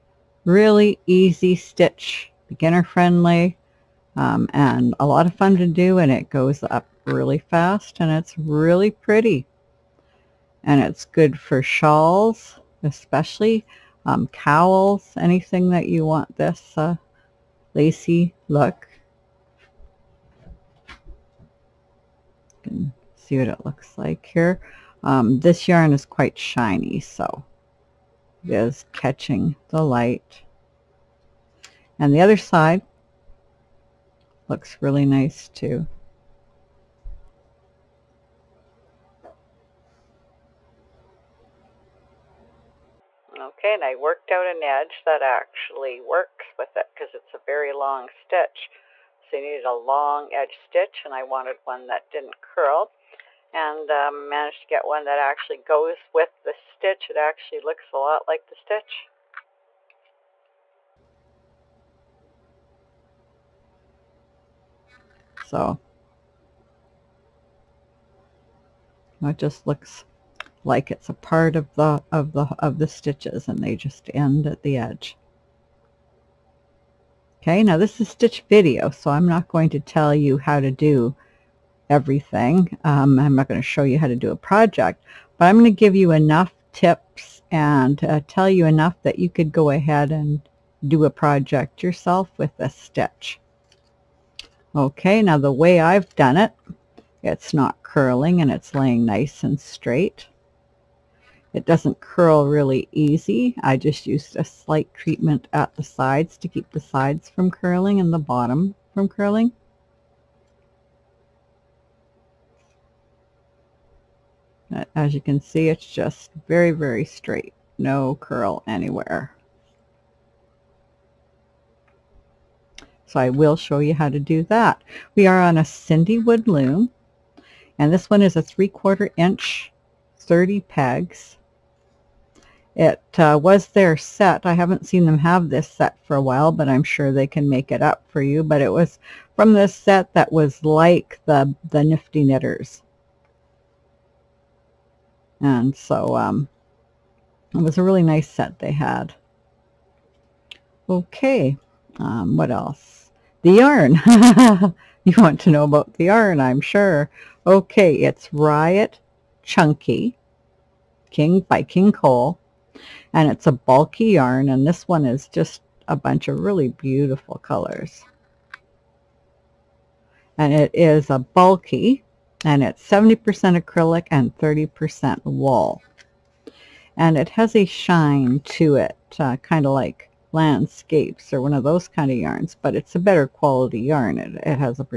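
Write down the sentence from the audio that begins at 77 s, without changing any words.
Okay, now this is stitch video, so I'm not going to tell you how to do everything.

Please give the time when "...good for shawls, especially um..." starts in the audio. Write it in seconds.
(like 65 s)
11 s.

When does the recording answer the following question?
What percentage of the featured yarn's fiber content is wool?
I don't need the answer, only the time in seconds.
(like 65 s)
174 s.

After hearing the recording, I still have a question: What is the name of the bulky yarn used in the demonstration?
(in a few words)
Riot Chunky.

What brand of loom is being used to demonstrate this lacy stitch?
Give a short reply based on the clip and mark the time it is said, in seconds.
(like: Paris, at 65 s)
CinDWood, at 125 s.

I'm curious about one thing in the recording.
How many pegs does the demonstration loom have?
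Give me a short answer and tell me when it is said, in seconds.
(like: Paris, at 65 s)
30, at 130 s.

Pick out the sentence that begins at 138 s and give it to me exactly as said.
But it was from this set that was like the, the Nifty Knitters.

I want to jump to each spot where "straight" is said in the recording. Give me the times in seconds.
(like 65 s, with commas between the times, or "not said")
99 s, 117 s.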